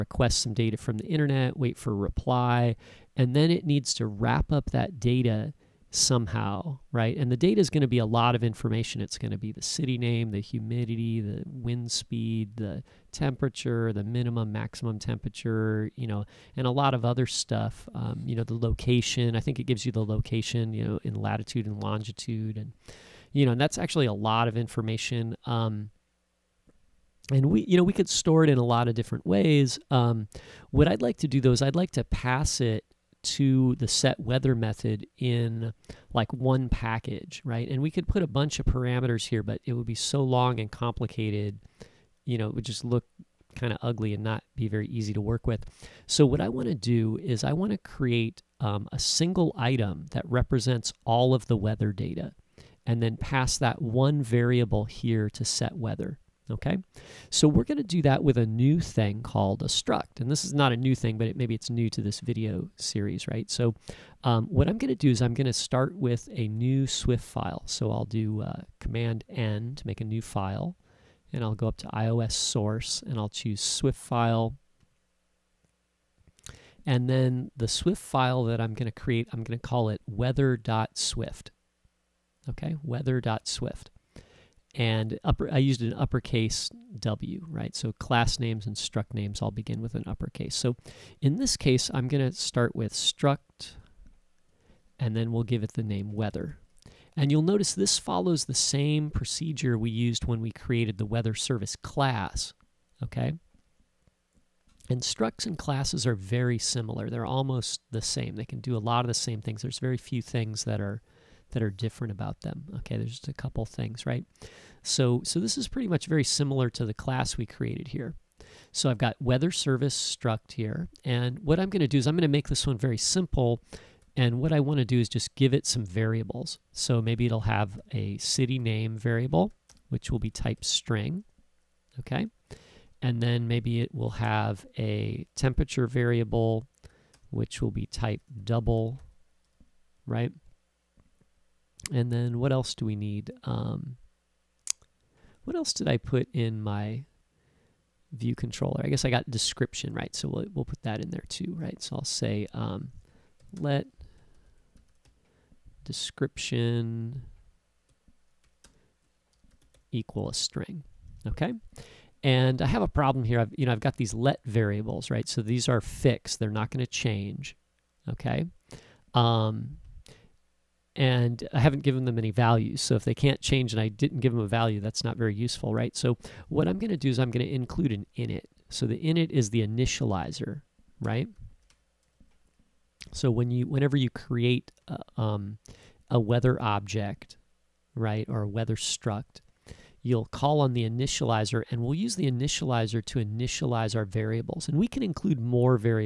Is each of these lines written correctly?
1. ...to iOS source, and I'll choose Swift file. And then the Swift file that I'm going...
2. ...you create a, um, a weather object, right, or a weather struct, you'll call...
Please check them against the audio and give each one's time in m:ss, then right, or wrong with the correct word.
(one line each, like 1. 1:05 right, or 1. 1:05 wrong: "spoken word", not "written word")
1. 1:11 right
2. 3:03 right.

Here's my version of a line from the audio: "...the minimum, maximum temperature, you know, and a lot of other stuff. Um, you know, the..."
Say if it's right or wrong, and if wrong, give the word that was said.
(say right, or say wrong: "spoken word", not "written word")
right.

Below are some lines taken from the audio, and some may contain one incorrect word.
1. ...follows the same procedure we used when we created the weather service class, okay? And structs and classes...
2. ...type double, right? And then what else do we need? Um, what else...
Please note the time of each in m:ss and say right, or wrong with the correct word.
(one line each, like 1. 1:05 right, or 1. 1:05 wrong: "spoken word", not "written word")
1. 1:37 right
2. 2:17 right.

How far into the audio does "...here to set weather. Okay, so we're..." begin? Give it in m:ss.
0:54.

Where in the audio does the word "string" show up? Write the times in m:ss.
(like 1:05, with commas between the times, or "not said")
2:10, 2:40.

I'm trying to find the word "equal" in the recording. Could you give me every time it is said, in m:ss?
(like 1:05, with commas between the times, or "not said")
2:39.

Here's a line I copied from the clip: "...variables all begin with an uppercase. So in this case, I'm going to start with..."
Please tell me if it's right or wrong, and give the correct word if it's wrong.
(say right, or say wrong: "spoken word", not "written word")
wrong: "names", not "variables".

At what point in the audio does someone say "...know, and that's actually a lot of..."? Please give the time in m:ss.
0:23.